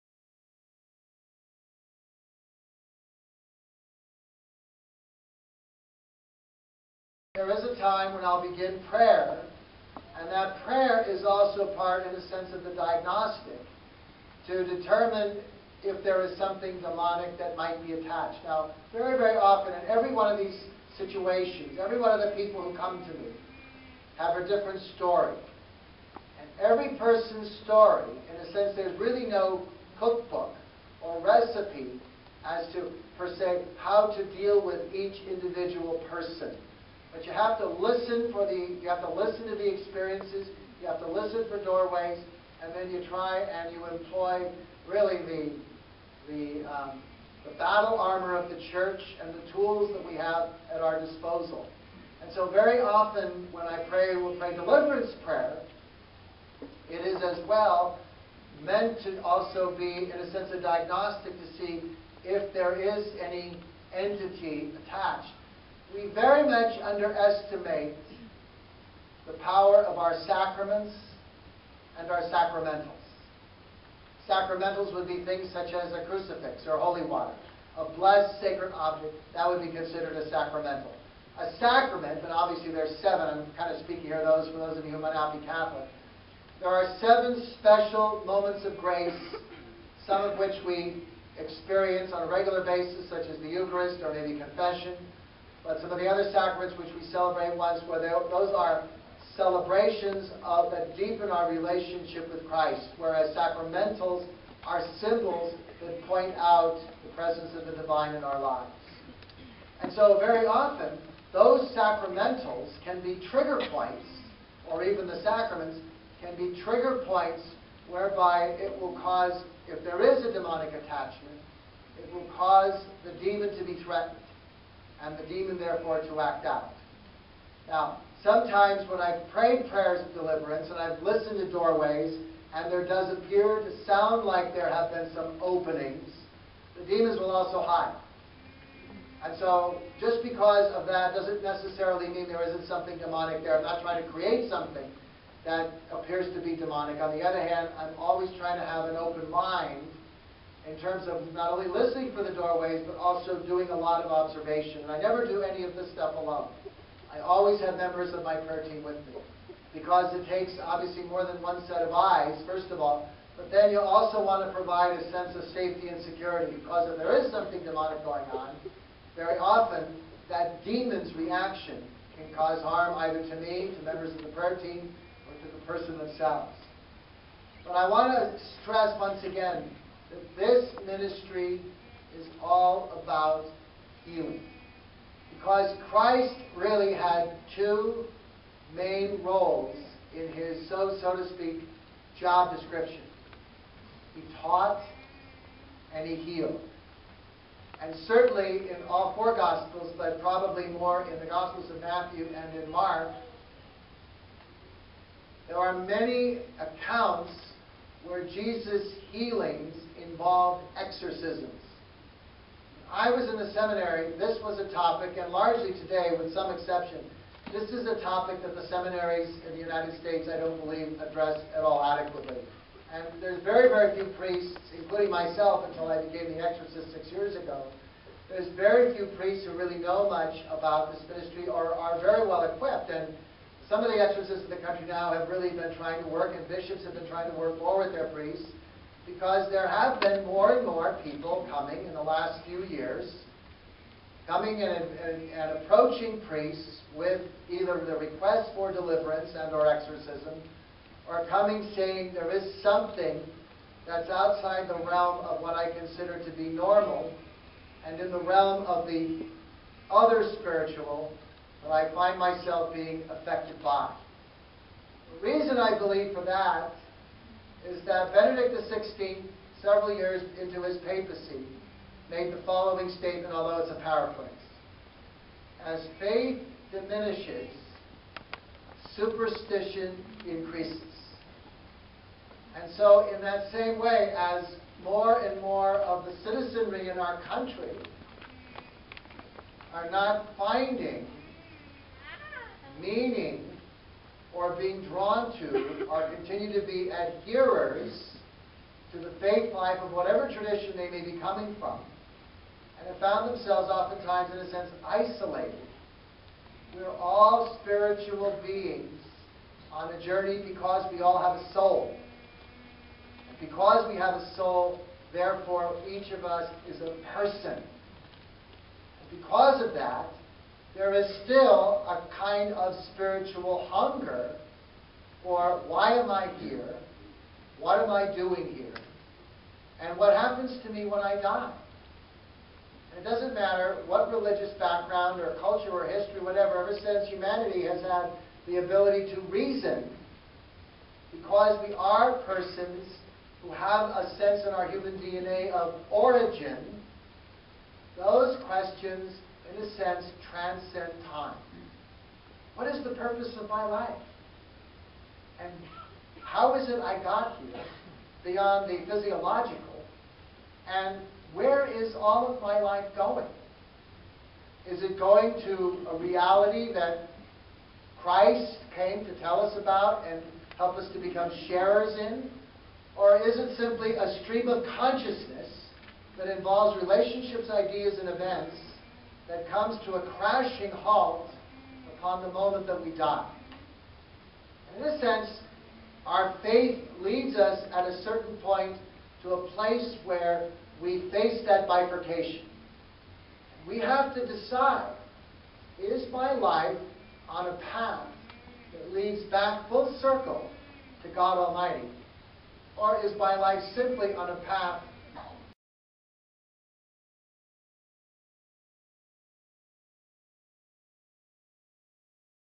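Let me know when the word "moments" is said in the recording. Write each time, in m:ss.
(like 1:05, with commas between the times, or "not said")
1:28, 6:22.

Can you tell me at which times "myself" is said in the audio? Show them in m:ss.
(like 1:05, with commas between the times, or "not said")
3:45, 4:22.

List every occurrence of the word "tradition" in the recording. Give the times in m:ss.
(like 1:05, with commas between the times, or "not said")
5:00.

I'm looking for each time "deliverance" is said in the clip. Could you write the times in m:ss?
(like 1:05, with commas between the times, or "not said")
0:54, 2:10, 4:08.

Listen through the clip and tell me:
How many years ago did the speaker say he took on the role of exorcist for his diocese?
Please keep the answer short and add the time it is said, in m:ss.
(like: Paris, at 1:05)
6, at 3:46.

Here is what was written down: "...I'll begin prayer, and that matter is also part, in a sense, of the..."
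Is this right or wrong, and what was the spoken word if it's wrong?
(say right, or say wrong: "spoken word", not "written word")
wrong: "prayer", not "matter".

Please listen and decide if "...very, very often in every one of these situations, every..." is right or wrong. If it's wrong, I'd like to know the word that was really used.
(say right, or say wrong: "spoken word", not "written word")
right.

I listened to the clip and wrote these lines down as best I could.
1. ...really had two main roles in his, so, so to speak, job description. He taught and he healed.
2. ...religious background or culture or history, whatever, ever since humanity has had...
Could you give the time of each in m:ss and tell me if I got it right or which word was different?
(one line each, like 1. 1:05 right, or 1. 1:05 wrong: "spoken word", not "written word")
1. 3:06 right
2. 5:34 right.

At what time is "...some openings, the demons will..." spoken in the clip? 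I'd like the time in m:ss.
2:15.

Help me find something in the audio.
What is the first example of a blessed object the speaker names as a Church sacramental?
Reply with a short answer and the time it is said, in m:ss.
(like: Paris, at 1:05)
Crucifix, at 1:16.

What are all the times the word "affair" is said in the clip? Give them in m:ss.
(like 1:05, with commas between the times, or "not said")
not said.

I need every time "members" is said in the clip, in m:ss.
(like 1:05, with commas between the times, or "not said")
2:37, 2:53.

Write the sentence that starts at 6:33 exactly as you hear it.
We have to decide, is my life on a path that leads back full circle to God Almighty?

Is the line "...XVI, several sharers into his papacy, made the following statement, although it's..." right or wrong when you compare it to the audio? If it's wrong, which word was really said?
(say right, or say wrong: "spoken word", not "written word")
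wrong: "years", not "sharers".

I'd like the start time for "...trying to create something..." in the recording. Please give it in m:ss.
2:23.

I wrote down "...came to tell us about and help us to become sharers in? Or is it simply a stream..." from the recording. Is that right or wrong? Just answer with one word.
right.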